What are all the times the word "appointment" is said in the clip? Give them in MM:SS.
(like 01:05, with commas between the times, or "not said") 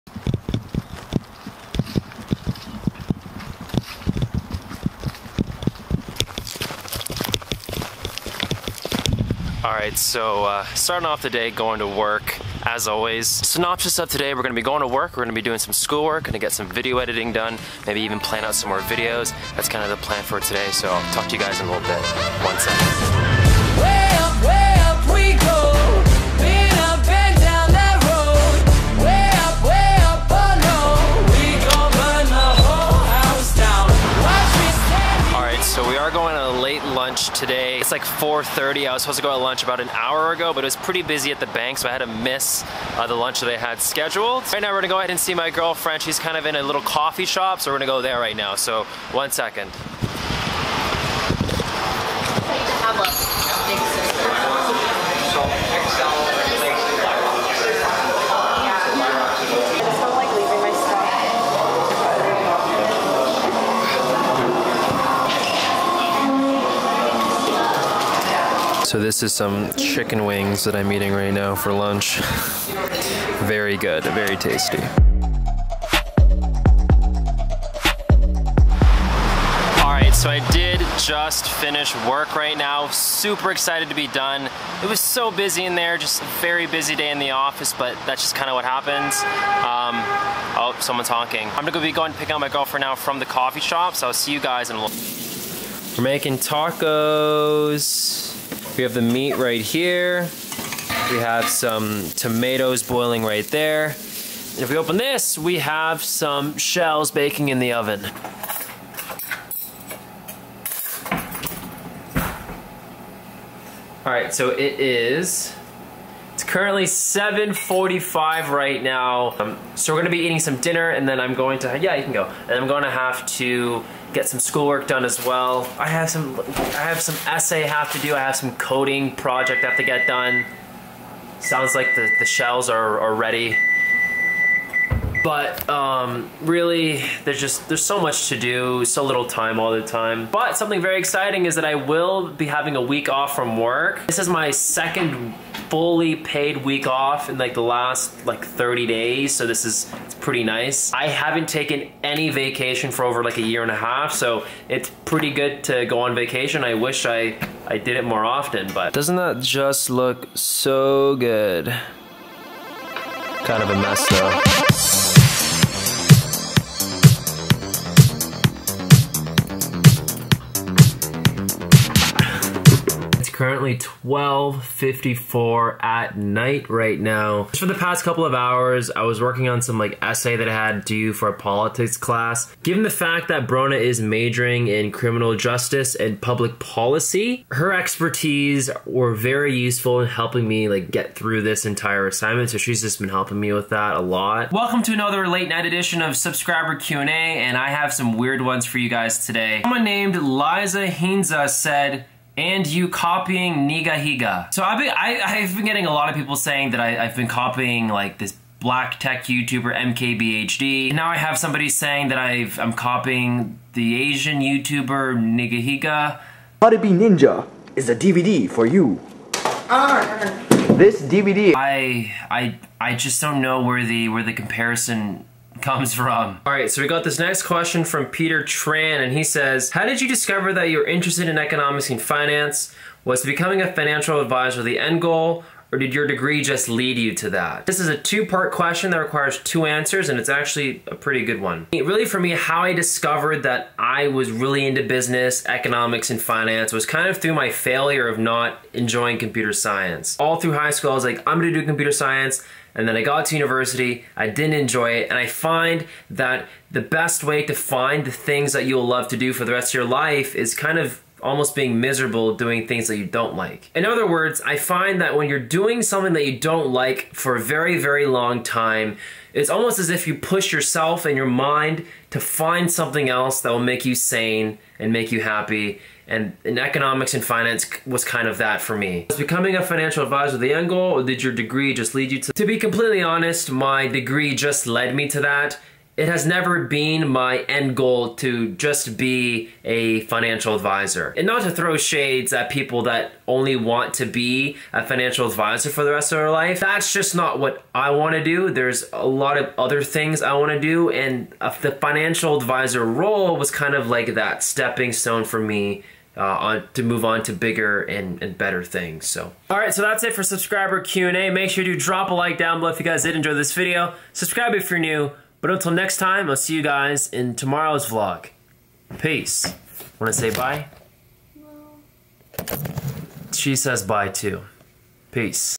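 not said.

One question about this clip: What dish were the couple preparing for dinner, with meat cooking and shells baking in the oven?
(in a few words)
Tacos.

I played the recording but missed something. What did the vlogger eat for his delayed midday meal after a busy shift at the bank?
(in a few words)
Chicken wings.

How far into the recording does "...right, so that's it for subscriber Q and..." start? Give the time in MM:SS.
05:09.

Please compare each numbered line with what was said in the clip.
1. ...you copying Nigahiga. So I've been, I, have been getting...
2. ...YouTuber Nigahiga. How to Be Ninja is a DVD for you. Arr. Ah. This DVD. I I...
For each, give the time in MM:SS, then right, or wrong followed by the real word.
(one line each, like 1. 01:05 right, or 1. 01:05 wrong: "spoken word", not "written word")
1. 03:22 right
2. 03:34 right.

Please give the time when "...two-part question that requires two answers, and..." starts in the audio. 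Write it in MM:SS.
03:57.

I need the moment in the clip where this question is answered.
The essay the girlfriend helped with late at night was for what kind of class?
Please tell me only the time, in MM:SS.
03:01.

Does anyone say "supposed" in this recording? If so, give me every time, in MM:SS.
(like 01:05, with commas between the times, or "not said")
00:39.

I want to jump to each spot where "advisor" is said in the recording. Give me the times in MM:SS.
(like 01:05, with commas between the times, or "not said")
03:54, 04:40, 04:50, 04:55, 05:02.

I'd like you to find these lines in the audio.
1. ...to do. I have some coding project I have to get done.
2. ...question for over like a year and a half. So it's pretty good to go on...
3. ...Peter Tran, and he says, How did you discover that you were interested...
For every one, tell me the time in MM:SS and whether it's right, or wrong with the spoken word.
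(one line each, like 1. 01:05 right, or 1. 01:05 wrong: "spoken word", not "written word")
1. 02:07 right
2. 02:32 wrong: "vacation", not "question"
3. 03:48 right.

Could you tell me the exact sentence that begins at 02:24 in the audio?
This is my second fully paid week off in like the last like 30 days.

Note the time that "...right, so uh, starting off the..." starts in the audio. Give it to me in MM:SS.
00:09.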